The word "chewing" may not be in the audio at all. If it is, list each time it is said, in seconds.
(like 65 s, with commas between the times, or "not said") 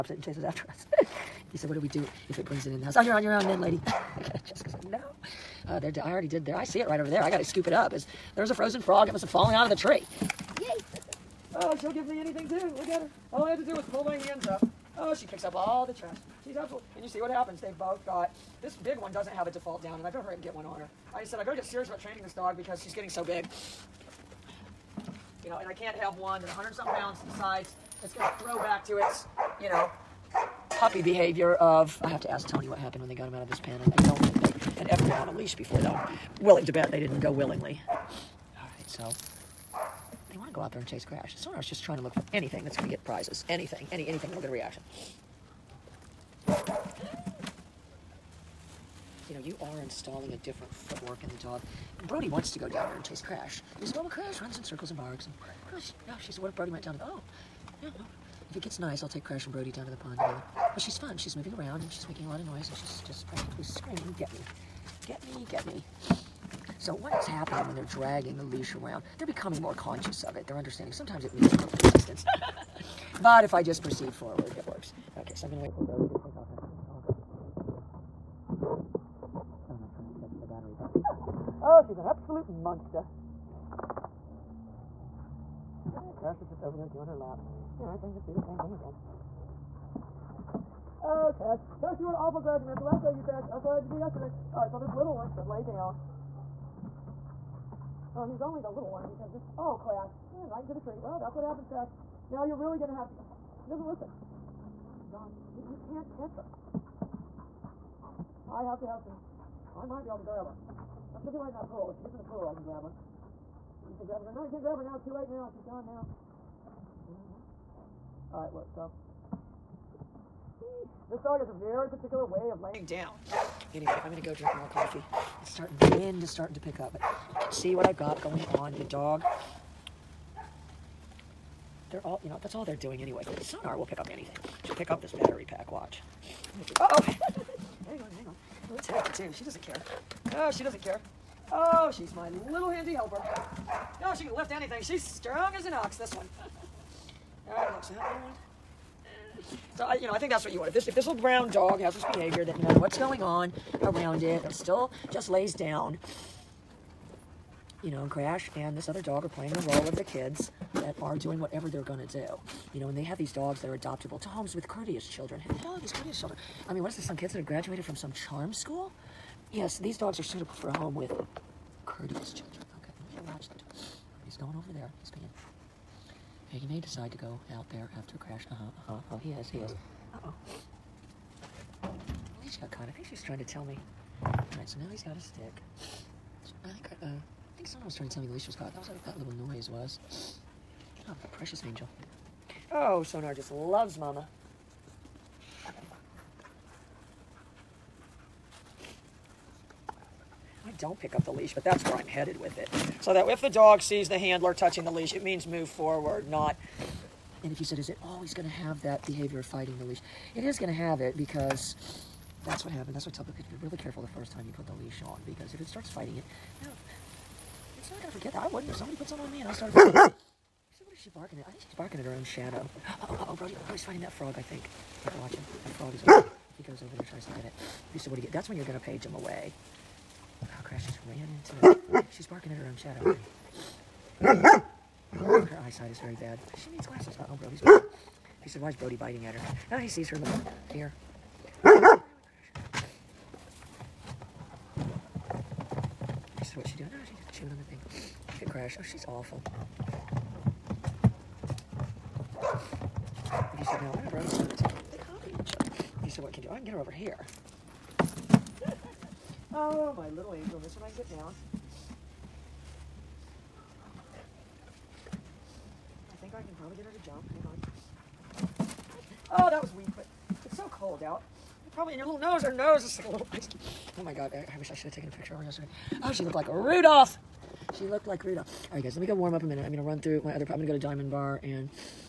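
247 s.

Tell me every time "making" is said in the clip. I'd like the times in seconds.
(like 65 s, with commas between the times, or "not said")
62 s.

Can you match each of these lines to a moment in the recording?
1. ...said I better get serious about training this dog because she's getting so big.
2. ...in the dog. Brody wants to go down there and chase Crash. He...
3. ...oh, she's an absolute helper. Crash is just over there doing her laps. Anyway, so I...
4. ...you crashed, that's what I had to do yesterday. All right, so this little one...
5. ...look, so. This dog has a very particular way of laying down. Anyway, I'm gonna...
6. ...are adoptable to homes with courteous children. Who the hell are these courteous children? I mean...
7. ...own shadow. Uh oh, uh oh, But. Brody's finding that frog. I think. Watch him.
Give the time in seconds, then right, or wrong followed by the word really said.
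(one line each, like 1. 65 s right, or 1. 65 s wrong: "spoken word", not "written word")
1. 21 s right
2. 51 s right
3. 81 s wrong: "monster", not "helper"
4. 93 s right
5. 118 s right
6. 163 s right
7. 222 s wrong: "Brody", not "But".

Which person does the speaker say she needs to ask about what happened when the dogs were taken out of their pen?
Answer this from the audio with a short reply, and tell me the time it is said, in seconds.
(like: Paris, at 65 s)
Tony, at 32 s.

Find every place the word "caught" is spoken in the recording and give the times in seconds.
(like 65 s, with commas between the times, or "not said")
182 s, 188 s.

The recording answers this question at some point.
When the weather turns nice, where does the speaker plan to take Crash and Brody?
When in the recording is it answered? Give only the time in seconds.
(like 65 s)
59 s.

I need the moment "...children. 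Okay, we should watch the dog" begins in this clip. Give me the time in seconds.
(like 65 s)
172 s.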